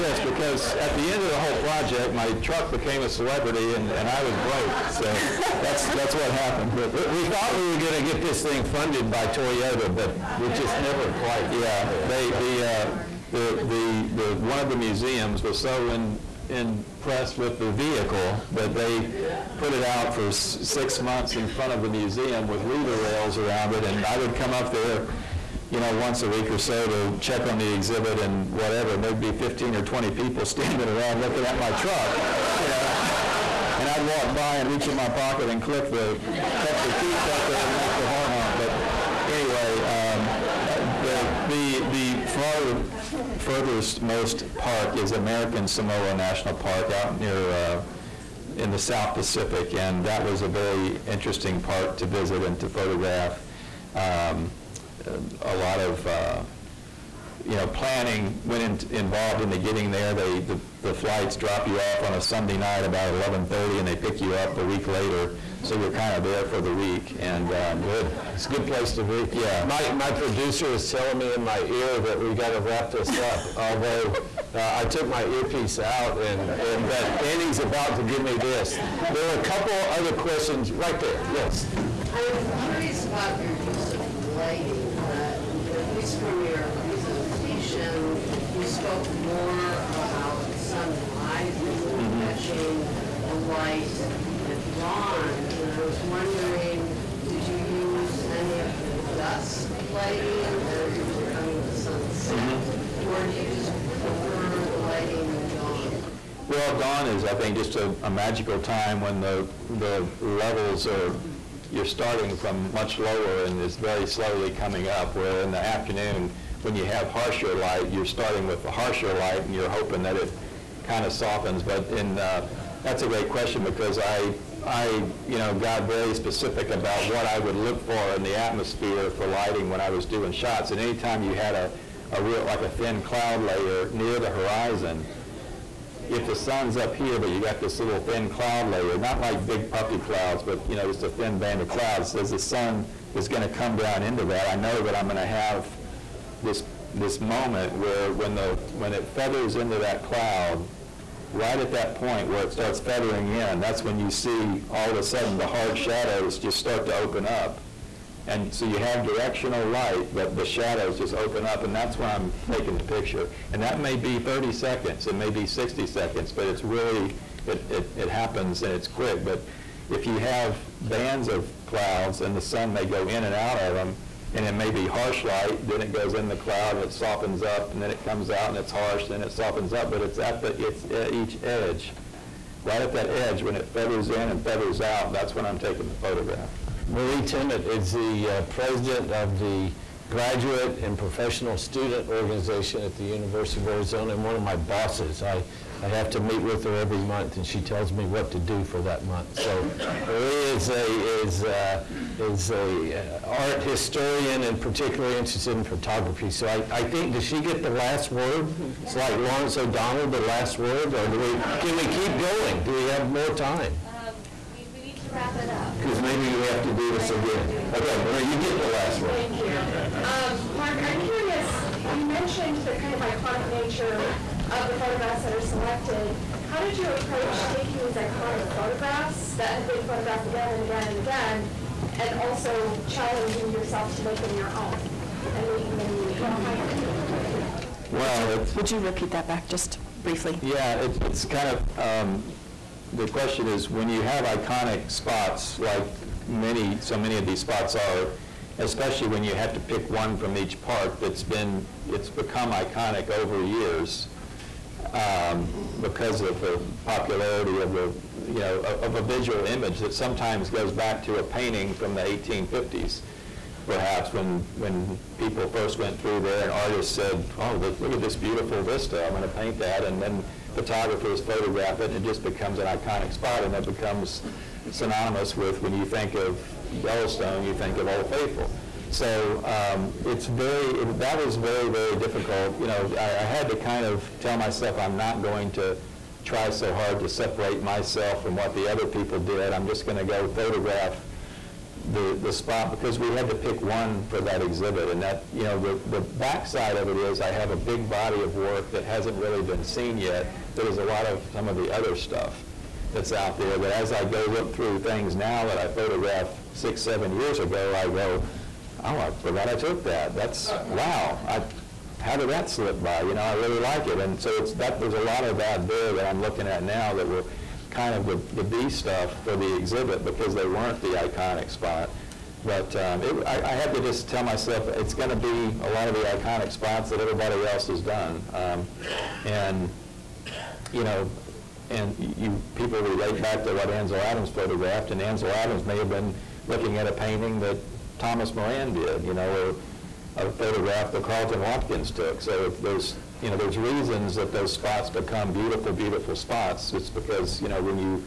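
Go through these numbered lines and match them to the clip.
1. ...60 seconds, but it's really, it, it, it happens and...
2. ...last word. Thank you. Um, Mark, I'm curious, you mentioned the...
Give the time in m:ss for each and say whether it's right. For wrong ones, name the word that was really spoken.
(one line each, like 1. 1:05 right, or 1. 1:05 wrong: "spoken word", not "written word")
1. 2:45 right
2. 3:38 right.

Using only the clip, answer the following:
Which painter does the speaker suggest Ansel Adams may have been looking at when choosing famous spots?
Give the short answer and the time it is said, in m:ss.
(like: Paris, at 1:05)
Thomas Moran, at 5:37.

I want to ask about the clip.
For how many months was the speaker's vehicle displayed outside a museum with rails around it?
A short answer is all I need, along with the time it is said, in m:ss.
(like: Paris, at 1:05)
6, at 0:20.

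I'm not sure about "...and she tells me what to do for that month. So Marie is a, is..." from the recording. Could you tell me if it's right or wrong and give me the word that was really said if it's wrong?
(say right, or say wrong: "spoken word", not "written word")
right.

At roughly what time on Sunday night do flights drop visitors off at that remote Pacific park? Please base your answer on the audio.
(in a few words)
11:30.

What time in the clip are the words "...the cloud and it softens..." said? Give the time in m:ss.
2:56.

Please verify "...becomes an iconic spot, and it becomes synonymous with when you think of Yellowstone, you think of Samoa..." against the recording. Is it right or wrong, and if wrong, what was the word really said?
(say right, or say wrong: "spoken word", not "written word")
wrong: "Old", not "Samoa".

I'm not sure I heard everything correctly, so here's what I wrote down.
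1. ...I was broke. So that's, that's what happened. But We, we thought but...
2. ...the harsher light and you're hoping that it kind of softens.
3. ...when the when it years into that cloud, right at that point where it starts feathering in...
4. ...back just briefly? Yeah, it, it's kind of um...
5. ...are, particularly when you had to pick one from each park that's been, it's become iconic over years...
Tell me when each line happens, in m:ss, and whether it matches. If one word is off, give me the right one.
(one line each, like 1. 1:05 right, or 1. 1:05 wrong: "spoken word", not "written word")
1. 0:04 right
2. 1:58 right
3. 2:28 wrong: "feathers", not "years"
4. 3:59 right
5. 4:07 wrong: "especially", not "particularly".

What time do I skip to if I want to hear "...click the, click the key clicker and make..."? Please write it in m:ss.
0:35.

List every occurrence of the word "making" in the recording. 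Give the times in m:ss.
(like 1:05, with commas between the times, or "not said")
3:55.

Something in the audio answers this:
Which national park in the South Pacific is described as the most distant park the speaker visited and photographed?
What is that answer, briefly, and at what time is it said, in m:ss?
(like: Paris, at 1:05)
American Samoa National Park, at 0:45.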